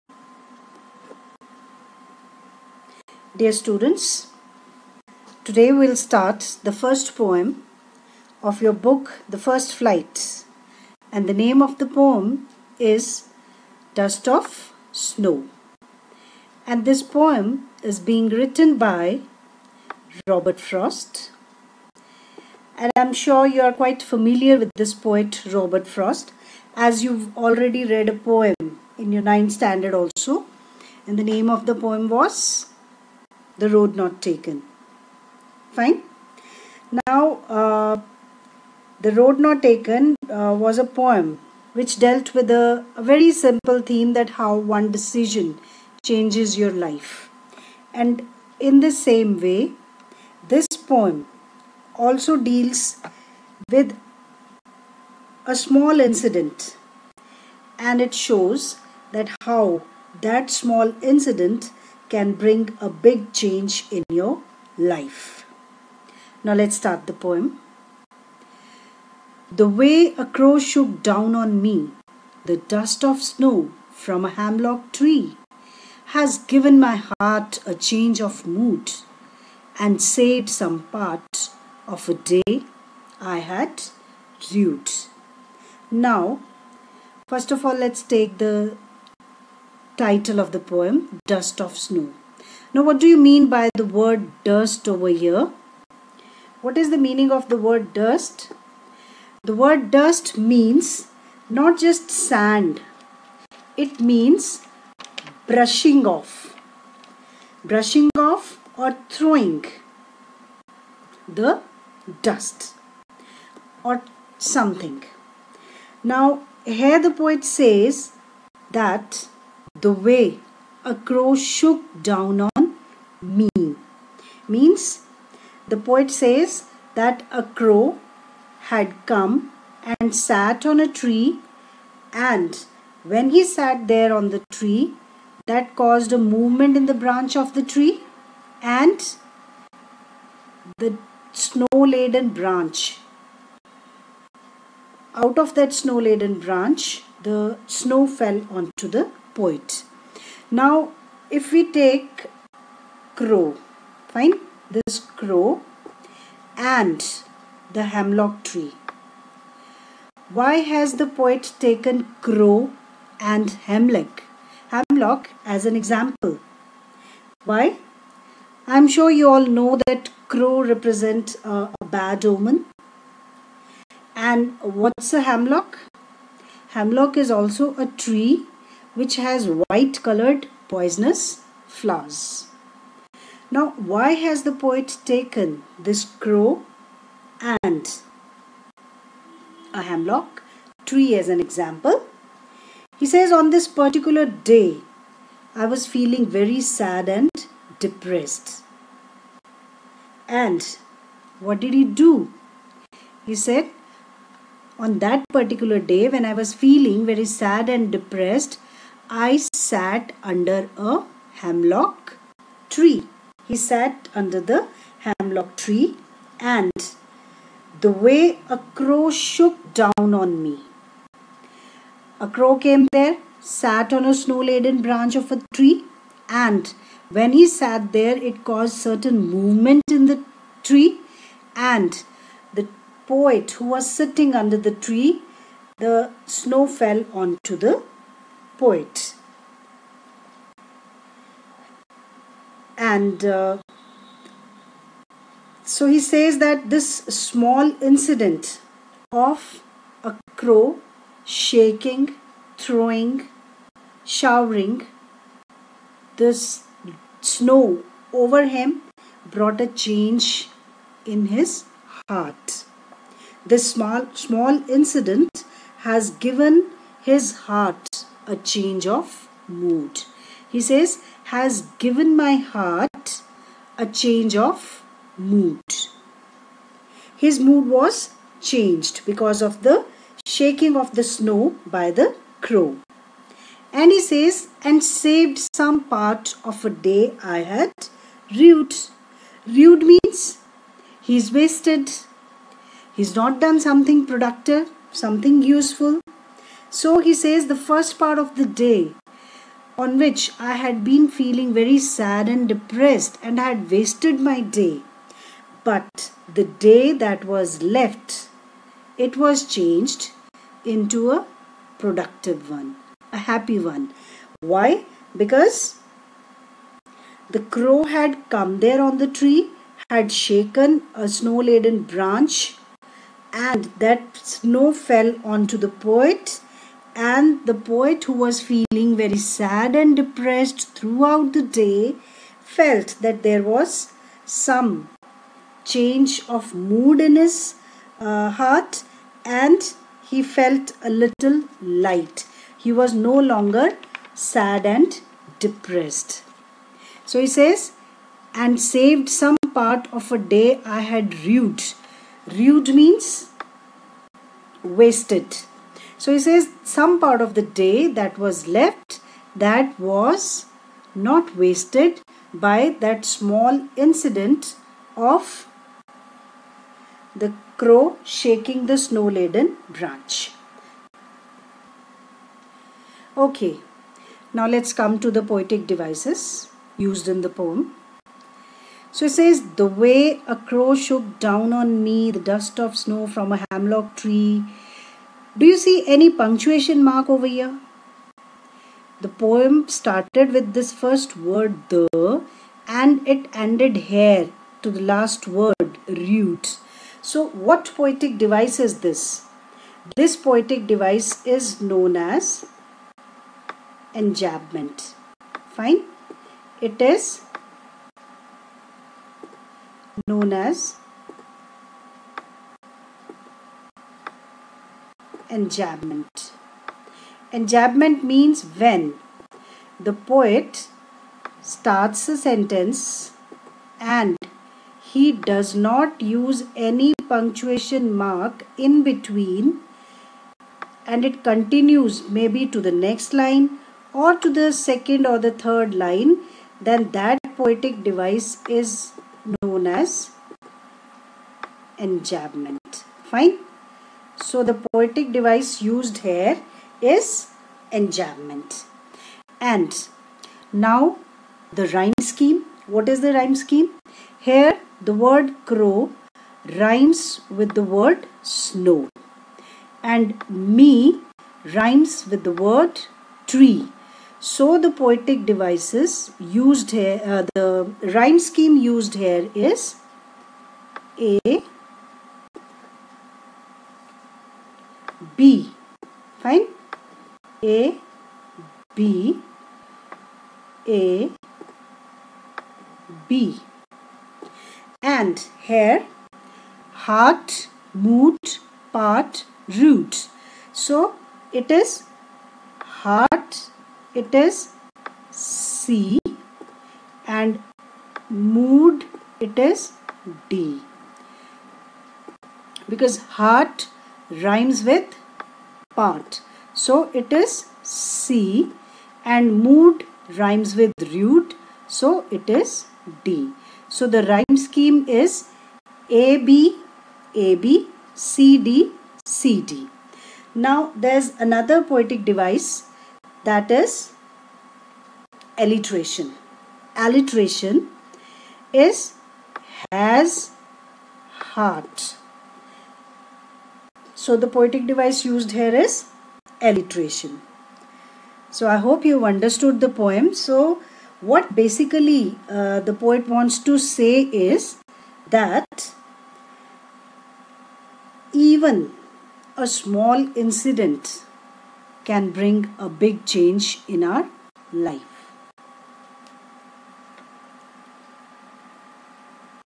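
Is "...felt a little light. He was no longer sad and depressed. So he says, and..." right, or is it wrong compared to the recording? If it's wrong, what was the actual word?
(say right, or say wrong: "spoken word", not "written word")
right.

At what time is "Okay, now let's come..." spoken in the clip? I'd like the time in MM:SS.
06:13.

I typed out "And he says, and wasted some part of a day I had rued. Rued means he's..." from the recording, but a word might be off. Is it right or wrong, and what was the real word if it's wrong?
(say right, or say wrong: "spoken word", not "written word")
wrong: "saved", not "wasted".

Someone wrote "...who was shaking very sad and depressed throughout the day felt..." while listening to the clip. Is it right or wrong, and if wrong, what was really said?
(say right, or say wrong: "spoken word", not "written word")
wrong: "feeling", not "shaking".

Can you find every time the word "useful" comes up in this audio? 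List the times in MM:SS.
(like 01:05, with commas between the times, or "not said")
04:55.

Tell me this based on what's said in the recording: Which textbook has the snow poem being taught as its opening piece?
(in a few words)
The First Flight.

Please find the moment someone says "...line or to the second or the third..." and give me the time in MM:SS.
07:13.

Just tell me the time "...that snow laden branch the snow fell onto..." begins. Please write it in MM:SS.
02:25.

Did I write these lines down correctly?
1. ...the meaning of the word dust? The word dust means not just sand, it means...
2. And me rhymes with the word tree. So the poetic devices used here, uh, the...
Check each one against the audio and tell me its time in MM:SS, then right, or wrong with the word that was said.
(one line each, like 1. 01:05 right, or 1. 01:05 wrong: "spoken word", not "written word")
1. 01:36 right
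2. 07:39 right.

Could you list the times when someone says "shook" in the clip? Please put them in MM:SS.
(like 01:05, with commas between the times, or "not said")
01:10, 02:01, 03:39, 06:20.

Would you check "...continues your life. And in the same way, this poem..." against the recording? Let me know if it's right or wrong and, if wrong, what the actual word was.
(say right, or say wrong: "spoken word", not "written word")
wrong: "changes", not "continues".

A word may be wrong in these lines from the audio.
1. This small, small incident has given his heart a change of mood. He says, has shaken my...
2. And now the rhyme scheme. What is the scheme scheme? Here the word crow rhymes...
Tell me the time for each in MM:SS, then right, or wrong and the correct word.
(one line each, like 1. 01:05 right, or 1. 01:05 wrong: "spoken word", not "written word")
1. 04:23 wrong: "given", not "shaken"
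2. 07:29 wrong: "rhyme", not "scheme".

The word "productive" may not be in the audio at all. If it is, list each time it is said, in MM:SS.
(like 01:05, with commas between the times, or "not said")
04:54, 05:11.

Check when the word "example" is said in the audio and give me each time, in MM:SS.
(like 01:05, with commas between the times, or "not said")
02:45, 03:11.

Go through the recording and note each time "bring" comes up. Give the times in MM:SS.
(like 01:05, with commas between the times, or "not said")
01:02, 09:12.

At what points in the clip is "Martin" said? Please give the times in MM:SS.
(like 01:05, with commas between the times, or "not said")
not said.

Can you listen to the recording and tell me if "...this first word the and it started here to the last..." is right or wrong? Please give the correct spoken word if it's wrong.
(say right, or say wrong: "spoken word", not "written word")
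wrong: "ended", not "started".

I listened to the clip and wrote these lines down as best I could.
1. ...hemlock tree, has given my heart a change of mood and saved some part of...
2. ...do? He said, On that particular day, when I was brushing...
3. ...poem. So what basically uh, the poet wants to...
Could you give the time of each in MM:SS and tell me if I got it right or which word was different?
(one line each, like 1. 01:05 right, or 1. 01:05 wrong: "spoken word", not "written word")
1. 01:14 right
2. 03:21 wrong: "feeling", not "brushing"
3. 08:59 right.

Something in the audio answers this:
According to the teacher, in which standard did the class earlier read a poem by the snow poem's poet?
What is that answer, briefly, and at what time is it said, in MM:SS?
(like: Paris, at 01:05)
ninth standard, at 00:29.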